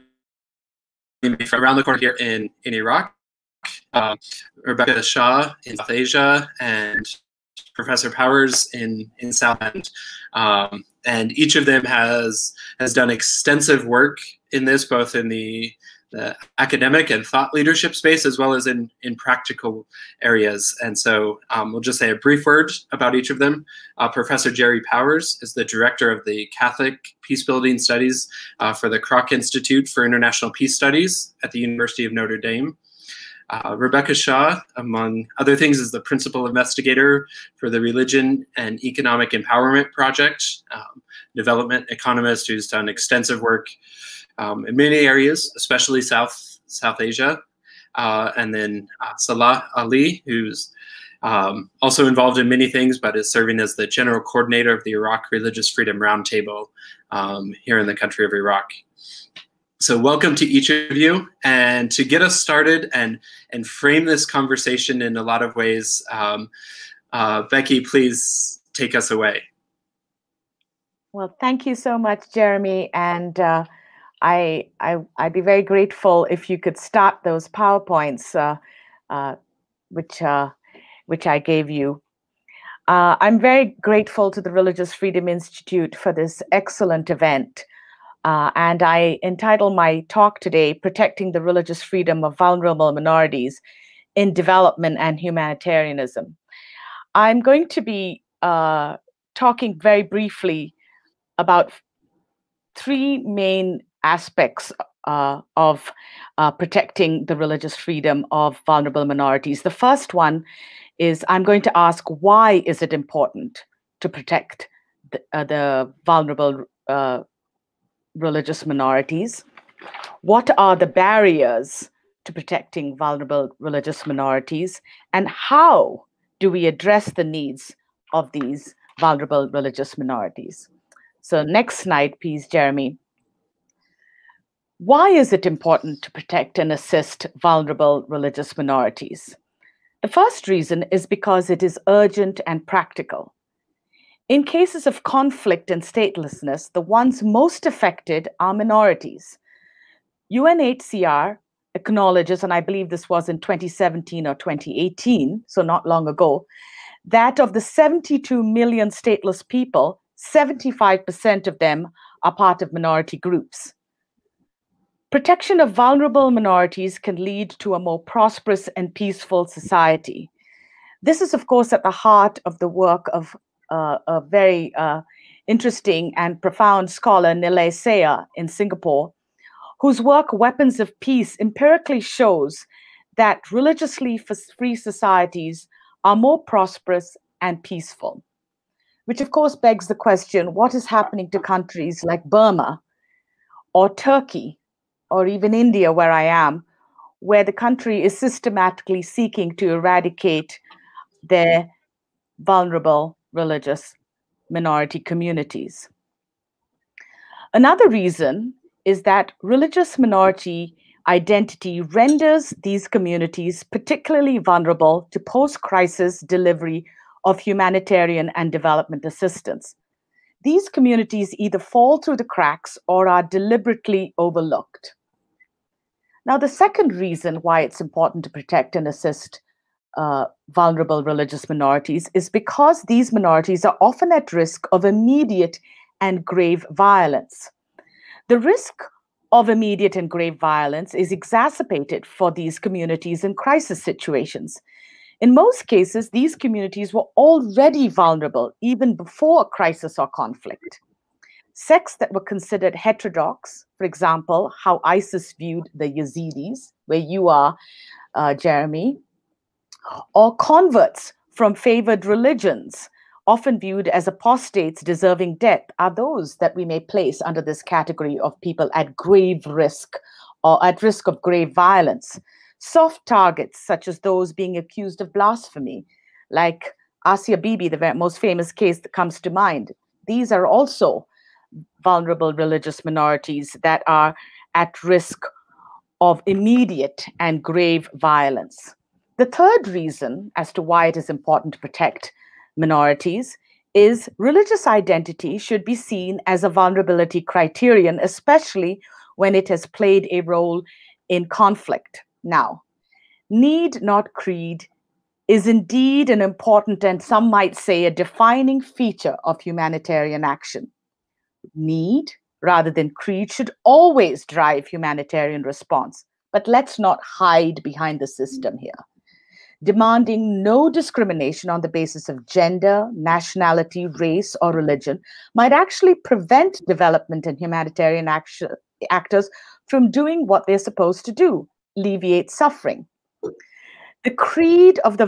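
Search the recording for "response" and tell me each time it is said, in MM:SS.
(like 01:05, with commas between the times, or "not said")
05:15.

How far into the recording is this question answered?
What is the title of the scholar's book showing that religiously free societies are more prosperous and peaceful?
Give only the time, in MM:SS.
03:00.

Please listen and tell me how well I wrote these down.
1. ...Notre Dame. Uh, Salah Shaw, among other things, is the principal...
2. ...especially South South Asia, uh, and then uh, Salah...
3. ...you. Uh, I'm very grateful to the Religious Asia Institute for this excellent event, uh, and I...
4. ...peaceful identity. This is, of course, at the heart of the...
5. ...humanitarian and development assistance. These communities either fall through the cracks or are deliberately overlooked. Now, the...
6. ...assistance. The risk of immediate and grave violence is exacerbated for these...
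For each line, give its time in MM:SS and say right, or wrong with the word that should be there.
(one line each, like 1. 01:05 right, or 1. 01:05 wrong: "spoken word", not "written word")
1. 00:32 wrong: "Rebecca", not "Salah"
2. 00:45 right
3. 01:21 wrong: "Freedom", not "Asia"
4. 02:48 wrong: "society", not "identity"
5. 03:37 right
6. 03:56 wrong: "violence", not "assistance".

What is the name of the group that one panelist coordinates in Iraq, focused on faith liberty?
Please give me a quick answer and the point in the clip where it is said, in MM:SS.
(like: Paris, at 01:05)
Iraq Religious Freedom Roundtable, at 00:54.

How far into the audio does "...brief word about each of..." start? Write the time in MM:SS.
00:22.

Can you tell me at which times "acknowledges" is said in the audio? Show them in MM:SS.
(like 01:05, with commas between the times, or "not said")
02:31.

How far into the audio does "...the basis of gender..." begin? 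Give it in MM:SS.
05:21.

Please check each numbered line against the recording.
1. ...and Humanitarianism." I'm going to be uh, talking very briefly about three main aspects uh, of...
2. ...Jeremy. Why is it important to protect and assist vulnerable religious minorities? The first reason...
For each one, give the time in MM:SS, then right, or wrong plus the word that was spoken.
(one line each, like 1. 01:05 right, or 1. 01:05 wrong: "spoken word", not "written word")
1. 01:34 right
2. 02:12 right.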